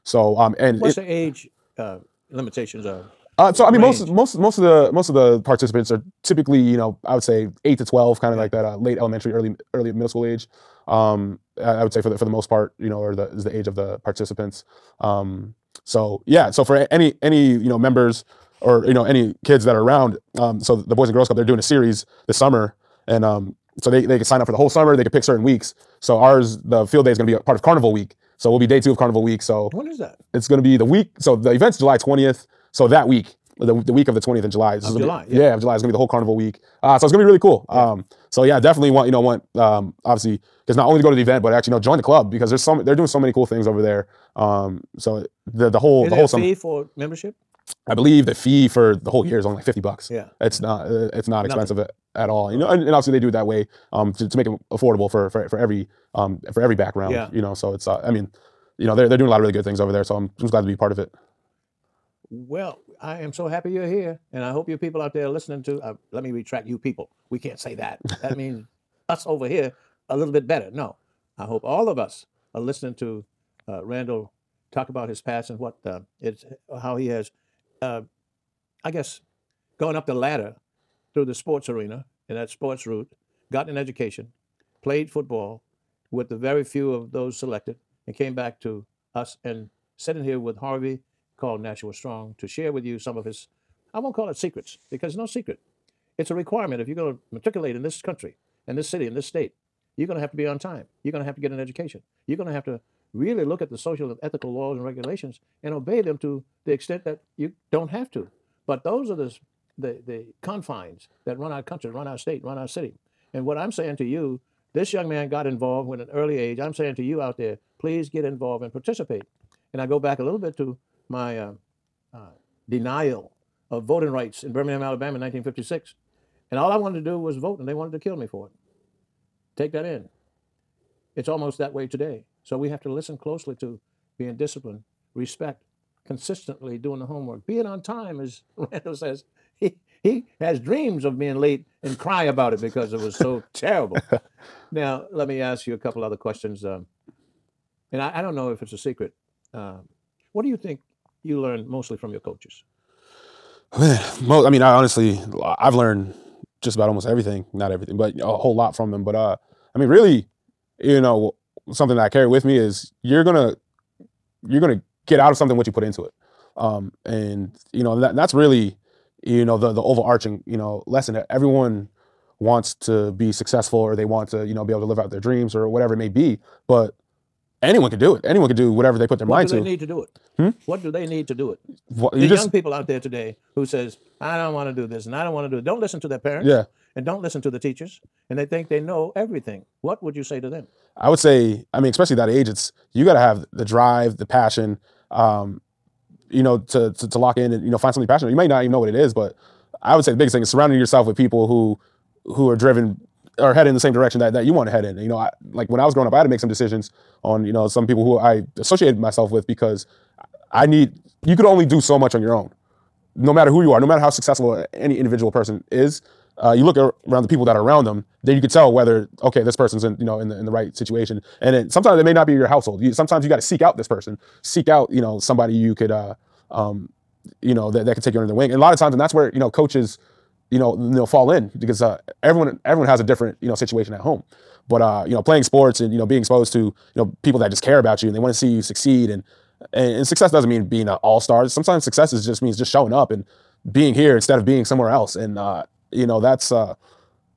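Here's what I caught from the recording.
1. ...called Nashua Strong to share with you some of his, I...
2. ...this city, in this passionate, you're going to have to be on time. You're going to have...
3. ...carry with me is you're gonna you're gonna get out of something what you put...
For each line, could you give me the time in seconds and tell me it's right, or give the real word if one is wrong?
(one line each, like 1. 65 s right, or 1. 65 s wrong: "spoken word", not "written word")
1. 91 s right
2. 98 s wrong: "state", not "passionate"
3. 162 s right.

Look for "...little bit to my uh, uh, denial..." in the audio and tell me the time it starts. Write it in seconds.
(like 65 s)
120 s.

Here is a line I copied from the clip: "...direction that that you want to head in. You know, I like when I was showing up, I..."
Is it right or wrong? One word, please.
wrong.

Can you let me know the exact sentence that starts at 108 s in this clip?
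But those are the, the, the confines that run our country, run our state, run our city.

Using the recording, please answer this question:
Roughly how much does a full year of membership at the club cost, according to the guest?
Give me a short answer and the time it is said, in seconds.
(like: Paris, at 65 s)
$50, at 49 s.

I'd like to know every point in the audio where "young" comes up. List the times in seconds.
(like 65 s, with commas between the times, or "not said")
114 s, 182 s.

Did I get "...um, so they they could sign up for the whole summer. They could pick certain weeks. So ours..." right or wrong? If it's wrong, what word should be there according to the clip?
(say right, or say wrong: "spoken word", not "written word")
right.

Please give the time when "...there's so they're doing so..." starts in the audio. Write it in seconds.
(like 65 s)
42 s.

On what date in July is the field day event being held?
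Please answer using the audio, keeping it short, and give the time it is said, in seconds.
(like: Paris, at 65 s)
July 20, at 31 s.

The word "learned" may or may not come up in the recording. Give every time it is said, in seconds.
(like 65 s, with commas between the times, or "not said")
151 s, 155 s.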